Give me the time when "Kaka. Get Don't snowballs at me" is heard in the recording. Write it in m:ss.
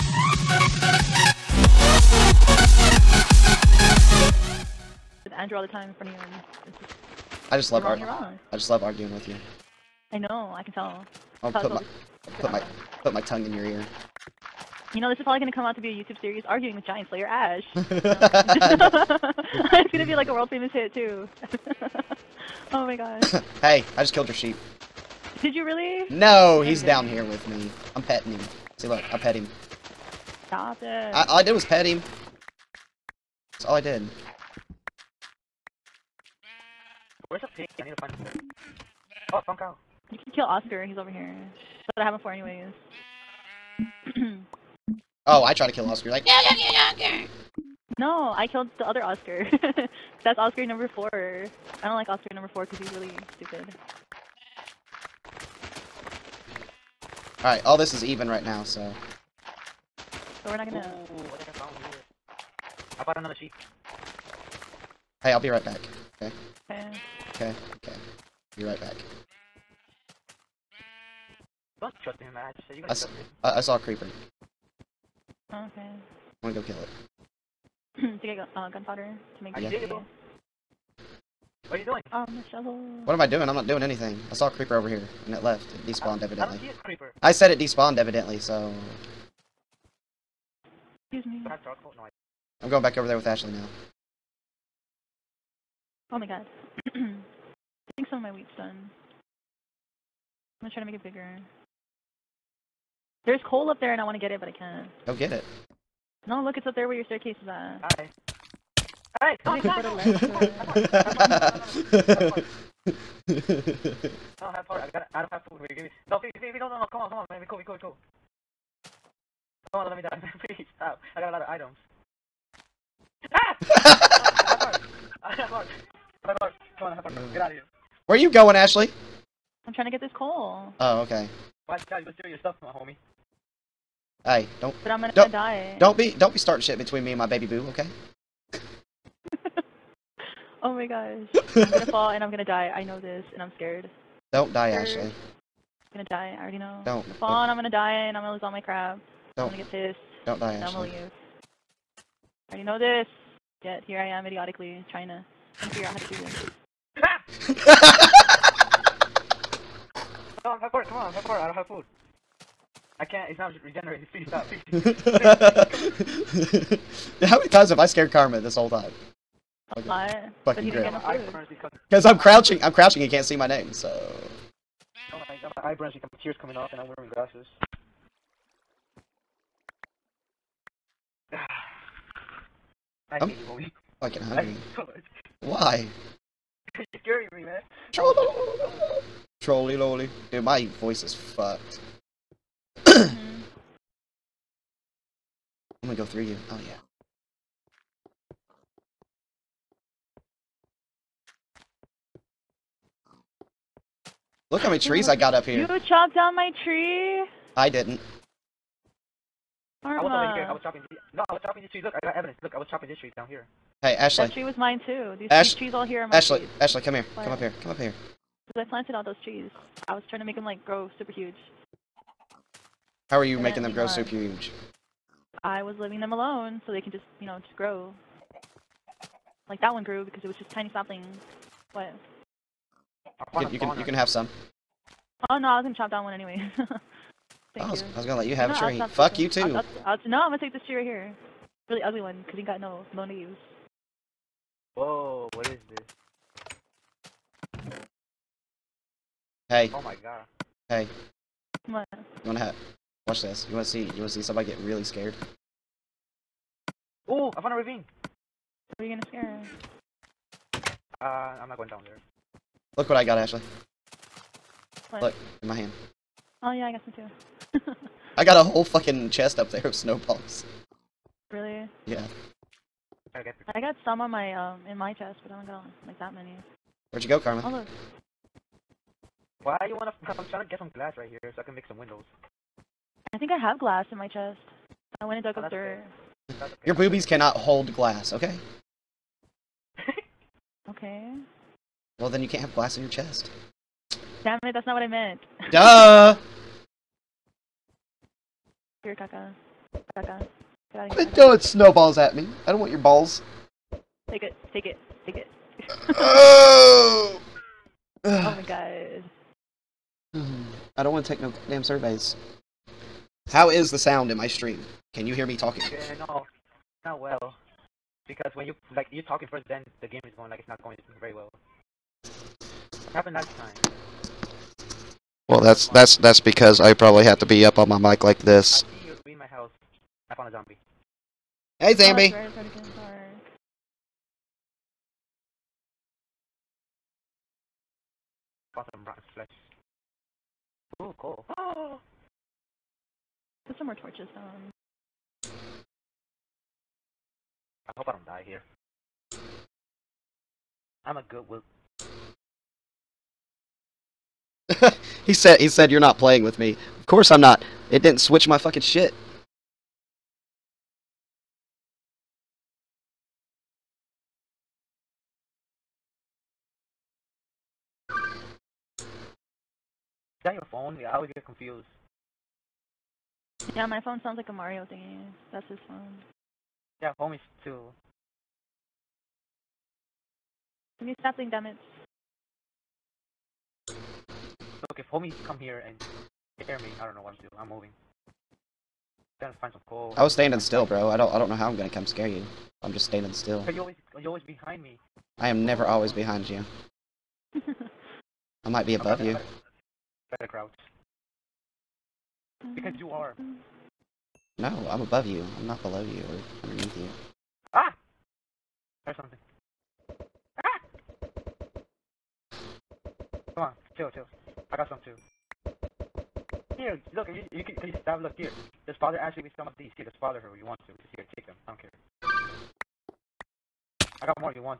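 4:59.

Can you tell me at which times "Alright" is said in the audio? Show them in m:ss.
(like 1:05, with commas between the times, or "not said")
0:57, 1:49.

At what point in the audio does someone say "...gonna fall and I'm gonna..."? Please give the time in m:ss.
2:21.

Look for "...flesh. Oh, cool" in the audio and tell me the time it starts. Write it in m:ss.
5:39.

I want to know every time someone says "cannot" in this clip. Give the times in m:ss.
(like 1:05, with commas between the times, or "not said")
4:47.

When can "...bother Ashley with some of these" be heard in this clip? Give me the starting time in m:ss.
6:58.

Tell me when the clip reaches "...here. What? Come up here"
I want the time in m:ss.
3:36.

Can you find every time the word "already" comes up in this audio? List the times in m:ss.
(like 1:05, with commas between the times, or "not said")
2:26, 2:32.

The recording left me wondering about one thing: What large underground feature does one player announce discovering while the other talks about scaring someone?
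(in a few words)
a ravine.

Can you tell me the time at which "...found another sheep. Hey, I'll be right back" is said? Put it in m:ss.
1:03.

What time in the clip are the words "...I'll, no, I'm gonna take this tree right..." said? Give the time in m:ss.
3:59.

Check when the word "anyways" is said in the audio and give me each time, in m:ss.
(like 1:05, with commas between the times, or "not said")
0:42, 3:56.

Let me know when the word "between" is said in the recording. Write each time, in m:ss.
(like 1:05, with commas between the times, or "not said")
2:16.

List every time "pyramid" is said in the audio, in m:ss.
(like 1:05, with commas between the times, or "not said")
not said.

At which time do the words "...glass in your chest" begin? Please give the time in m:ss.
4:52.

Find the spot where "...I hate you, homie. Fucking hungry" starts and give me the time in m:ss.
3:03.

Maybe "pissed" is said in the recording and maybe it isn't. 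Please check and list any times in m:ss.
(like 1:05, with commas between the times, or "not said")
2:29.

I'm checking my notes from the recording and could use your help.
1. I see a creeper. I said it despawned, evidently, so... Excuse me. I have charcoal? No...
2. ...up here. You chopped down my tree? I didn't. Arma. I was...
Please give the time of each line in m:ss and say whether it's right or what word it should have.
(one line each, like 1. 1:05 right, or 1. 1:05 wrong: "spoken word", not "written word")
1. 1:26 right
2. 3:25 right.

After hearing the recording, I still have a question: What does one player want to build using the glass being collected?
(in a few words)
windows.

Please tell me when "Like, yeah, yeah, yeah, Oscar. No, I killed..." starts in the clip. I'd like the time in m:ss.
0:46.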